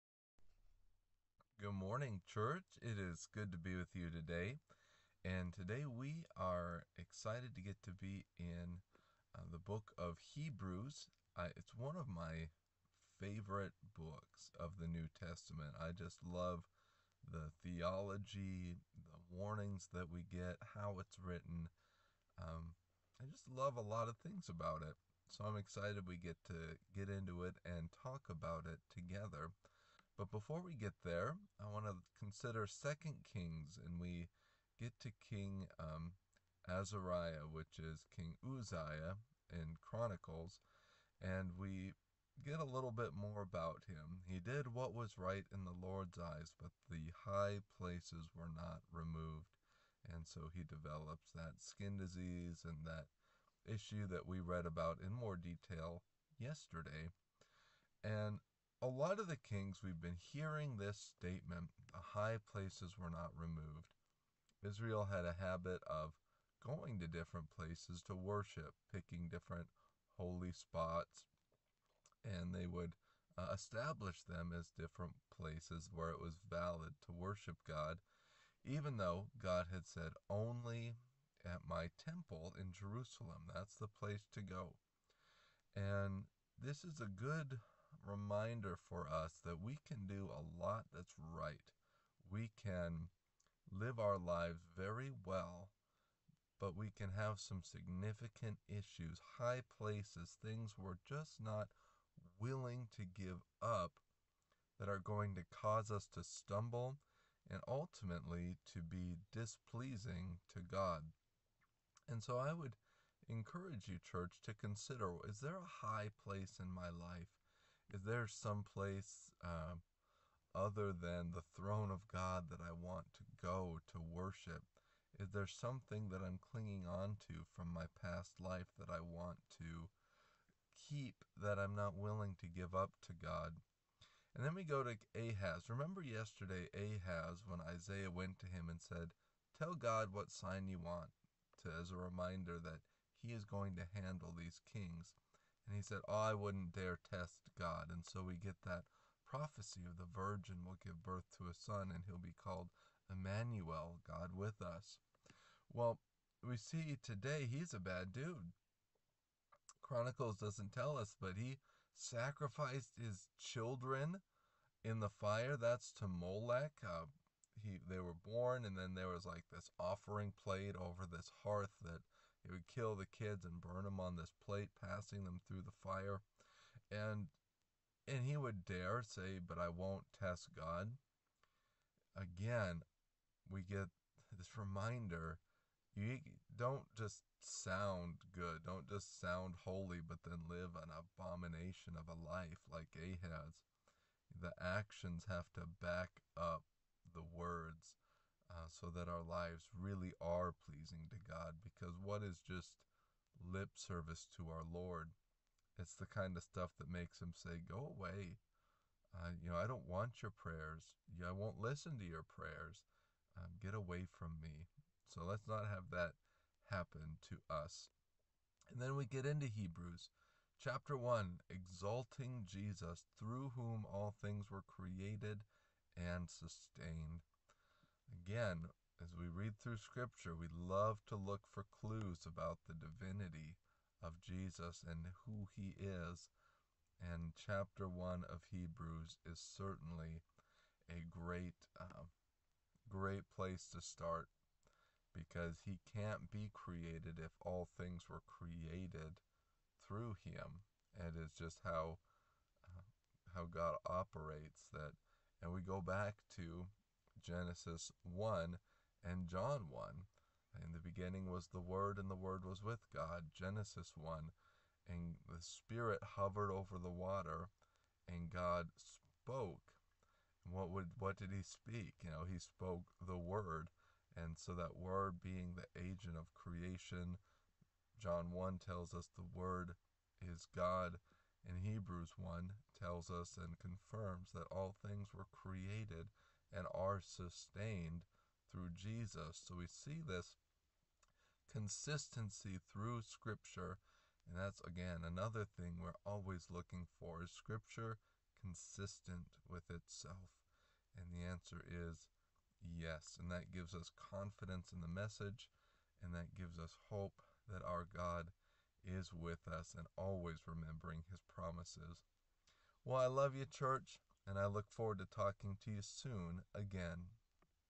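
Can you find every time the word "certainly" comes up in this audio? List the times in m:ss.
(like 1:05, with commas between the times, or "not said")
3:59.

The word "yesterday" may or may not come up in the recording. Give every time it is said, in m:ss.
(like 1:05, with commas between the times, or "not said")
0:56, 2:16.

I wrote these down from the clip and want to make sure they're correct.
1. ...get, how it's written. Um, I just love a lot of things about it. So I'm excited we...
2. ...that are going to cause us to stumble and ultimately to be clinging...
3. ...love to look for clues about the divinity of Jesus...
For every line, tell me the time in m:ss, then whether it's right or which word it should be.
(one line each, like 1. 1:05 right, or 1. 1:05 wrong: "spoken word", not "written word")
1. 0:20 right
2. 1:44 wrong: "displeasing", not "clinging"
3. 3:50 right.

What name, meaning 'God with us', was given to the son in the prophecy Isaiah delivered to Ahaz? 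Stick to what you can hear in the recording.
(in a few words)
Emmanuel.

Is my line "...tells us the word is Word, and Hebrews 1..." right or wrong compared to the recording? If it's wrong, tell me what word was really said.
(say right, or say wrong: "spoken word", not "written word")
wrong: "God", not "Word".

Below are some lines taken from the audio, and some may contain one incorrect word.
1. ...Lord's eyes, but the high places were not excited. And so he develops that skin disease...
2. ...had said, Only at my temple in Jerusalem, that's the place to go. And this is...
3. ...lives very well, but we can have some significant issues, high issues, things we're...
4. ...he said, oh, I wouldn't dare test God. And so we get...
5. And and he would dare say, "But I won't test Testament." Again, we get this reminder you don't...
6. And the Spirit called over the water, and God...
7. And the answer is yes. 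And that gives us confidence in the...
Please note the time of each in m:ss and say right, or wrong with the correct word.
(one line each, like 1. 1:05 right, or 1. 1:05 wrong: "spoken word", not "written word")
1. 0:45 wrong: "removed", not "excited"
2. 1:19 right
3. 1:34 wrong: "places", not "issues"
4. 2:25 right
5. 2:56 wrong: "God", not "Testament"
6. 4:24 wrong: "hovered", not "called"
7. 5:00 right.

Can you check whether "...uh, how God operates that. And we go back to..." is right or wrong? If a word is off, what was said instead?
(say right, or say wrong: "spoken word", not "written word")
right.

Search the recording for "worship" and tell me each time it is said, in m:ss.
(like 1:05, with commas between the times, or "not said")
1:08, 1:17, 2:03.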